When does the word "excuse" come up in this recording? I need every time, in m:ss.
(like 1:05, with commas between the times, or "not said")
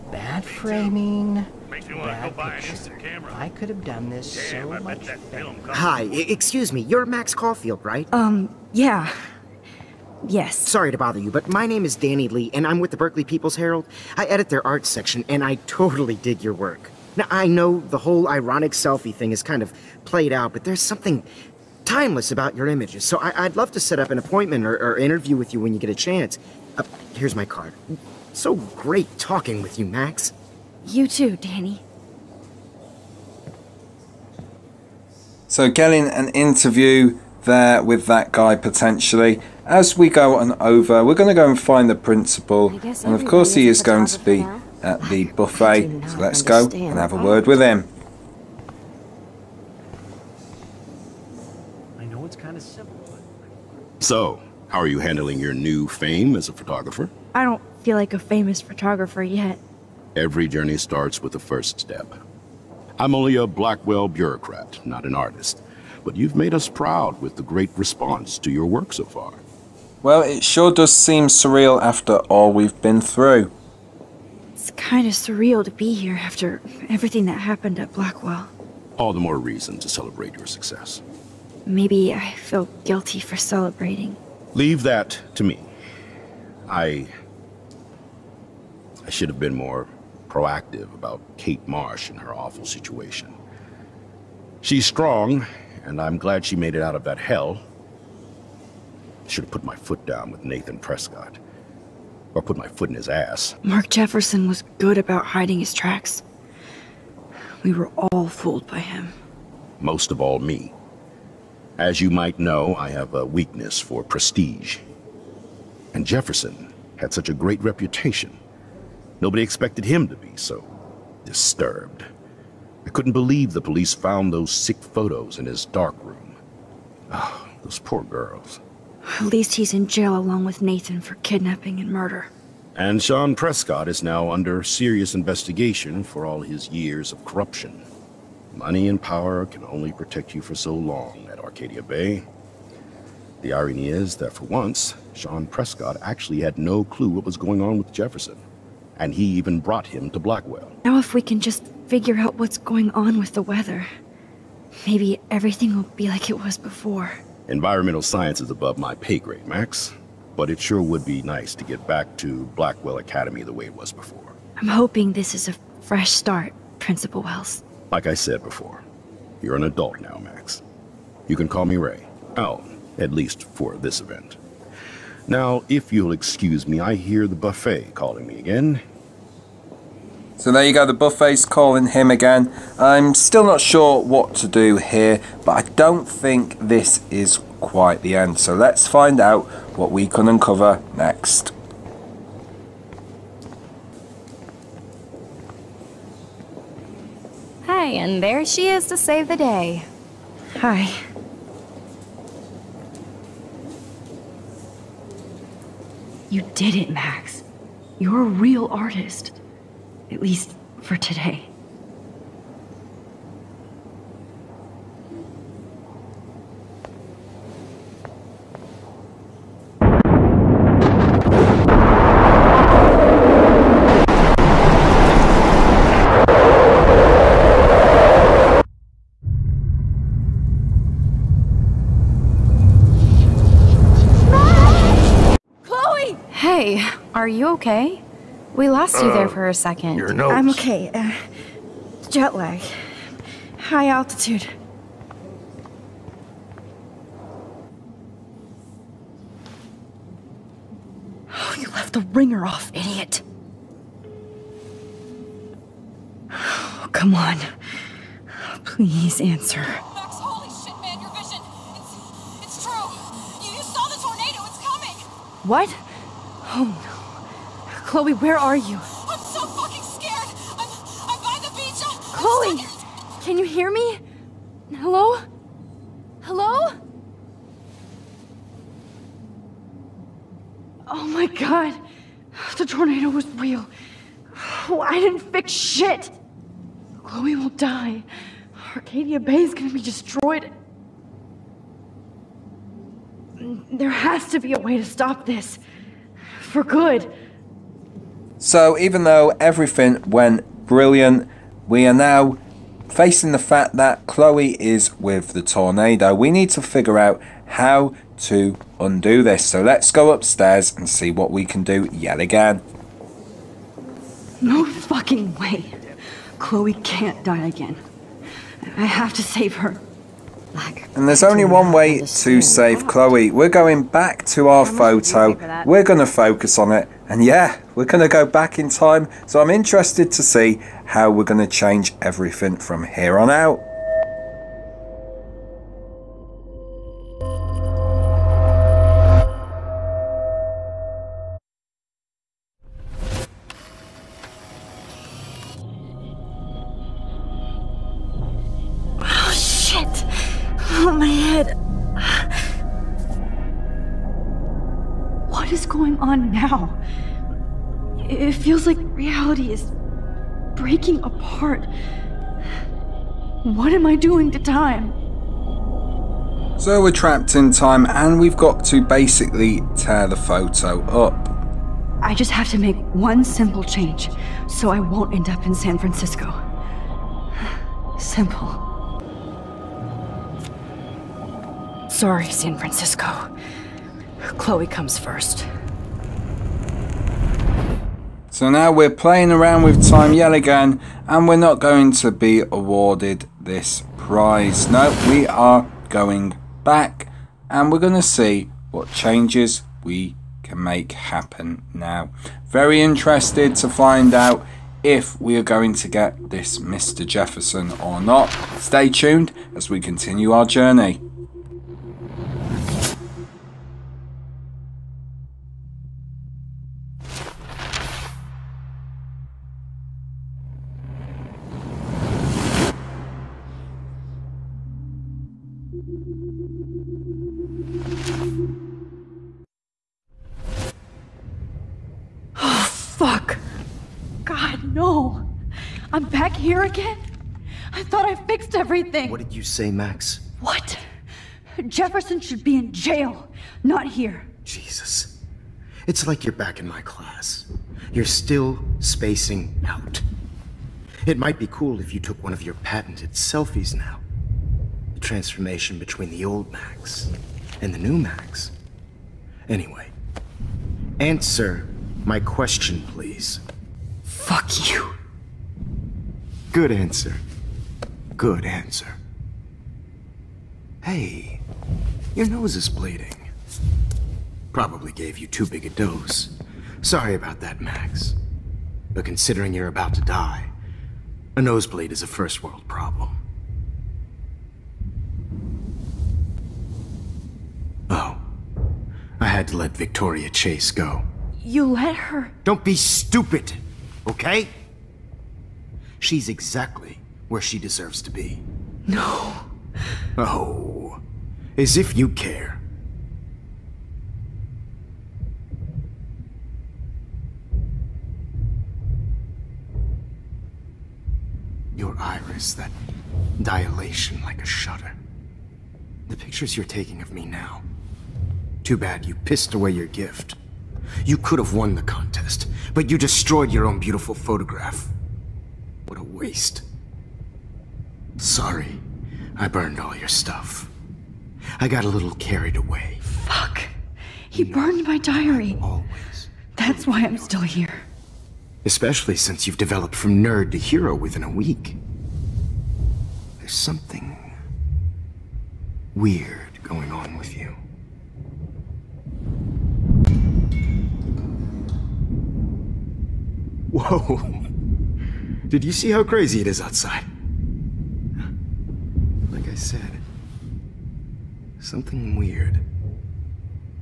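0:06, 2:56.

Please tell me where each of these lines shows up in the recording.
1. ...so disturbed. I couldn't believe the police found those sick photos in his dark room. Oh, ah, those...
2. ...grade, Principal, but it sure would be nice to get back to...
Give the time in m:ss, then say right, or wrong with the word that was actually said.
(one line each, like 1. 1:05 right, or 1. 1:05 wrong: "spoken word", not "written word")
1. 2:00 right
2. 2:39 wrong: "Max", not "Principal".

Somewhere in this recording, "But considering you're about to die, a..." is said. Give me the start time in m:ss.
7:58.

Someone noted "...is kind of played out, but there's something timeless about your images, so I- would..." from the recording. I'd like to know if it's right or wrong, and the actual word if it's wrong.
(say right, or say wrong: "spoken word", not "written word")
right.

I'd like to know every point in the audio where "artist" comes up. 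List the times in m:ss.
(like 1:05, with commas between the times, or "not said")
1:05, 3:28.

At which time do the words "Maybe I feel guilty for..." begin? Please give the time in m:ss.
1:21.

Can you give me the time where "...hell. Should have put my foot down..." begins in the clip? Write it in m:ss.
1:37.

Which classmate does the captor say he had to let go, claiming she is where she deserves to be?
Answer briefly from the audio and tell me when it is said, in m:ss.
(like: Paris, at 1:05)
Victoria Chase, at 8:09.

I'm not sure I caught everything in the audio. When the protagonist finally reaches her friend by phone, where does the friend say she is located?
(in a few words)
by the beach.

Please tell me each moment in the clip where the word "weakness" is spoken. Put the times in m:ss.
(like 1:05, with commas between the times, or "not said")
1:53.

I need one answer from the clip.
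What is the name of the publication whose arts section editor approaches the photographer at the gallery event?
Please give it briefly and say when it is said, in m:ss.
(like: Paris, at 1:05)
Berkeley People's Herald, at 0:12.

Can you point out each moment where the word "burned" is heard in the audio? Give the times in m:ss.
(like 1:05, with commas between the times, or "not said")
8:49, 8:54.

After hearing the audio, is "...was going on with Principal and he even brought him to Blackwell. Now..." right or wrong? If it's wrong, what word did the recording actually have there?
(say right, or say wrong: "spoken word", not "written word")
wrong: "Jefferson", not "Principal".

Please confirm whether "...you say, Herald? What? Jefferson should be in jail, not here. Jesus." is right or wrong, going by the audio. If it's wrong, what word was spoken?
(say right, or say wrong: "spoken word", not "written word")
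wrong: "Max", not "Herald".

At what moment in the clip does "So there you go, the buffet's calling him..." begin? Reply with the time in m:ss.
3:00.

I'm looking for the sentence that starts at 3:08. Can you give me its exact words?
So let's find out what we can uncover next.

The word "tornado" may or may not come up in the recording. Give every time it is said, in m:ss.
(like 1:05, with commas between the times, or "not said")
4:42, 5:05.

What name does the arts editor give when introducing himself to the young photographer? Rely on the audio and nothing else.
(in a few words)
Danny Lee.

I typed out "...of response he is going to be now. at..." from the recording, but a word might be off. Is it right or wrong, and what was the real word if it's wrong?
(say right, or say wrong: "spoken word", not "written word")
wrong: "course", not "response".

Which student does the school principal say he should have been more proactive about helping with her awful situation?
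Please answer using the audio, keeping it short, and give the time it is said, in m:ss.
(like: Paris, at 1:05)
Kate Marsh, at 1:31.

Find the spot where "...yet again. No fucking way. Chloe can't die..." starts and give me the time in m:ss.
5:11.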